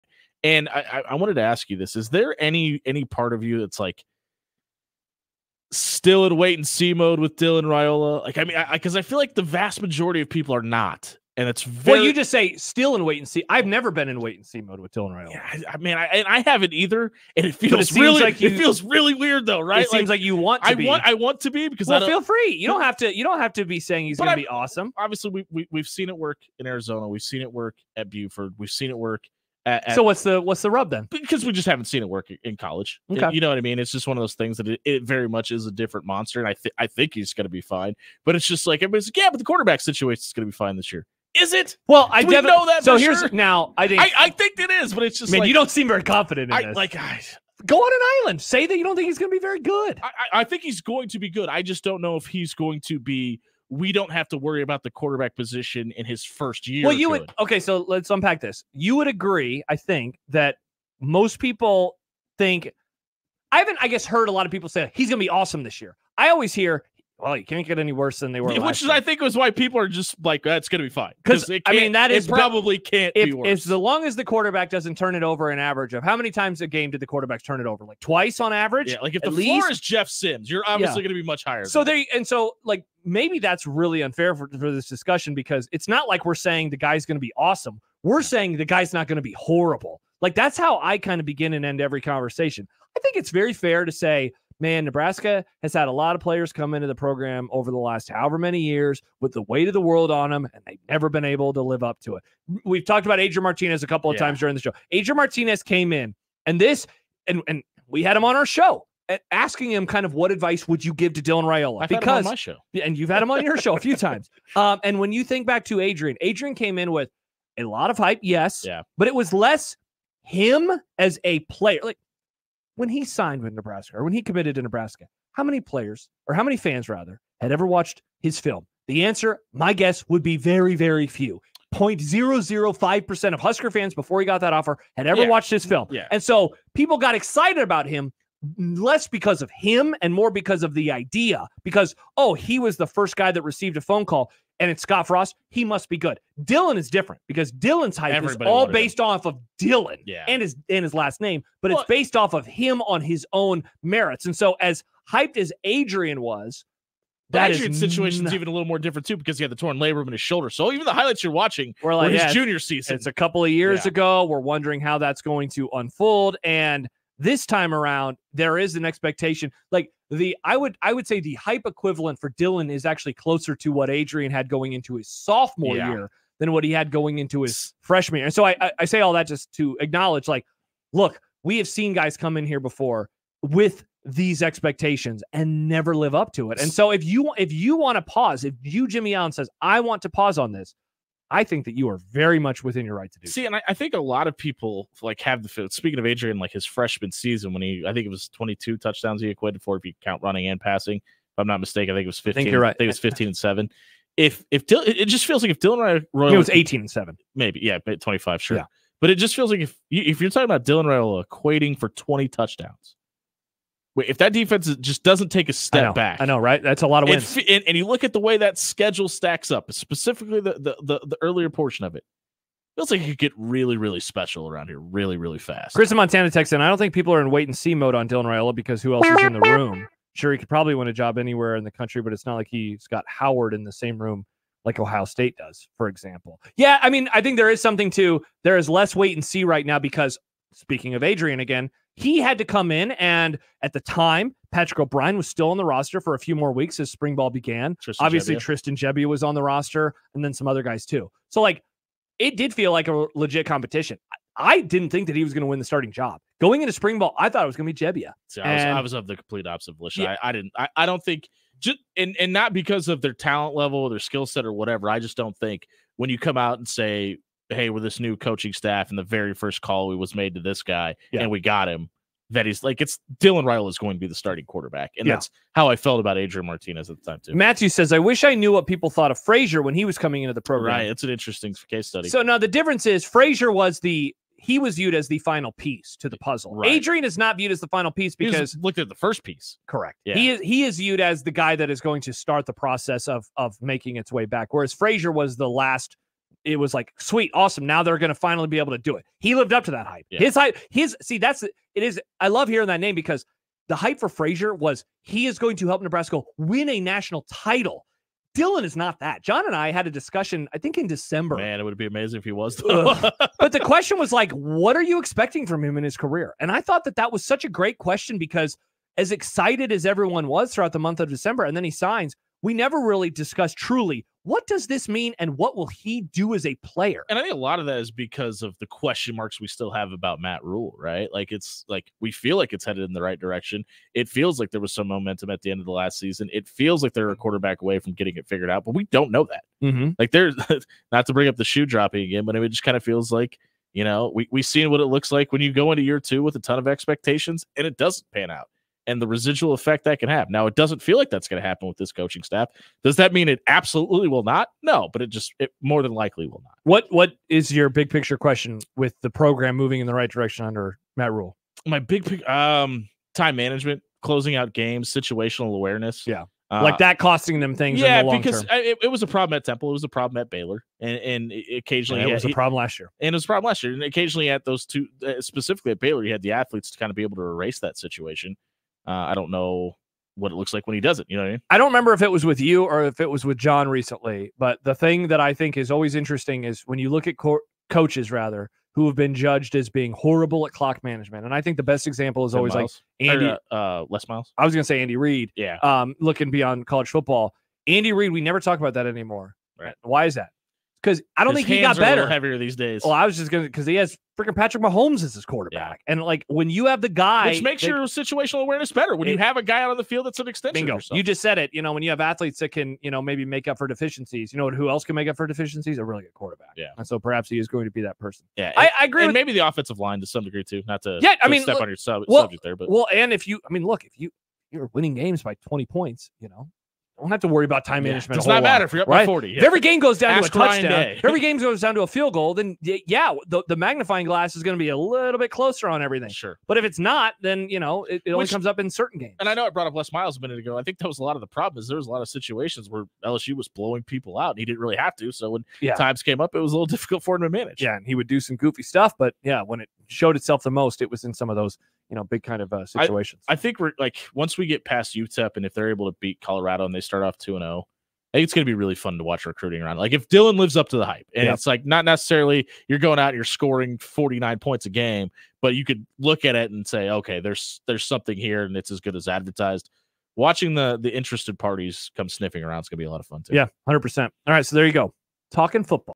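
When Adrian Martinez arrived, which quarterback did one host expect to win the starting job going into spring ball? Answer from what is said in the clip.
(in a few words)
Tristan Gebbia.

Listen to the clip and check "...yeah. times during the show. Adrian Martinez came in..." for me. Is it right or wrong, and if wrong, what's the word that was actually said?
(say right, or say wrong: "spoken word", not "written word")
right.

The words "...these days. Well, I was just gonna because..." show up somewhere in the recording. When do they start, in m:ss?
6:42.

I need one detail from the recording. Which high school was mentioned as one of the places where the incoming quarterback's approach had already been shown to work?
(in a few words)
Buford.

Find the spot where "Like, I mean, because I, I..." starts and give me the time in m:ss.
0:08.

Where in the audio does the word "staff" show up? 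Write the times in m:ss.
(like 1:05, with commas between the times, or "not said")
4:28, 5:52.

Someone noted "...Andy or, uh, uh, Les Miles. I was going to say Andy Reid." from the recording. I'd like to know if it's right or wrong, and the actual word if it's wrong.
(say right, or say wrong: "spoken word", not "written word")
right.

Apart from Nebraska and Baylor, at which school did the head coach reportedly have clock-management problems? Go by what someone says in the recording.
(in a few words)
Temple.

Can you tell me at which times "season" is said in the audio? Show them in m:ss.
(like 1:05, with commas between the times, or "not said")
2:42, 3:17, 5:35.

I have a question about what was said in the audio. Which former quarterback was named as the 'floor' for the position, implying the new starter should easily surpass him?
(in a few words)
Jeff Sims.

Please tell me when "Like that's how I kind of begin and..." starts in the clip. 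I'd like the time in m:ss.
1:30.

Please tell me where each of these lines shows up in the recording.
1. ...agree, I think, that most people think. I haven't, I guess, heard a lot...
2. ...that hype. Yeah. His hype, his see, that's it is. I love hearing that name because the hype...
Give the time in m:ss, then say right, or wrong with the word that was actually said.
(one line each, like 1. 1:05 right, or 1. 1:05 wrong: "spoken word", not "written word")
1. 0:59 right
2. 4:59 right.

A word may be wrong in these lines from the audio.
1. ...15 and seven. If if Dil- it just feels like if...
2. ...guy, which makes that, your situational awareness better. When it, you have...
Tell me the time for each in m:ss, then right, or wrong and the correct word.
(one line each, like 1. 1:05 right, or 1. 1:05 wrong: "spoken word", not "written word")
1. 3:22 right
2. 6:46 right.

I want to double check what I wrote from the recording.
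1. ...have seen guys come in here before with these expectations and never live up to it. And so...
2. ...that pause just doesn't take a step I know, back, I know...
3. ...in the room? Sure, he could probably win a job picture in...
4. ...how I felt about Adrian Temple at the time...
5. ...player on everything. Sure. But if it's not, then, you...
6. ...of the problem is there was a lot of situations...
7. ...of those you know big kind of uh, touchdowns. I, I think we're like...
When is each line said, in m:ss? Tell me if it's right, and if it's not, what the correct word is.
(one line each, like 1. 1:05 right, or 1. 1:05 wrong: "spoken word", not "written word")
1. 3:01 right
2. 3:34 wrong: "defense", not "pause"
3. 3:49 wrong: "anywhere", not "picture"
4. 4:35 wrong: "Martinez", not "Temple"
5. 7:15 wrong: "closer", not "player"
6. 7:21 right
7. 7:31 wrong: "situations", not "touchdowns".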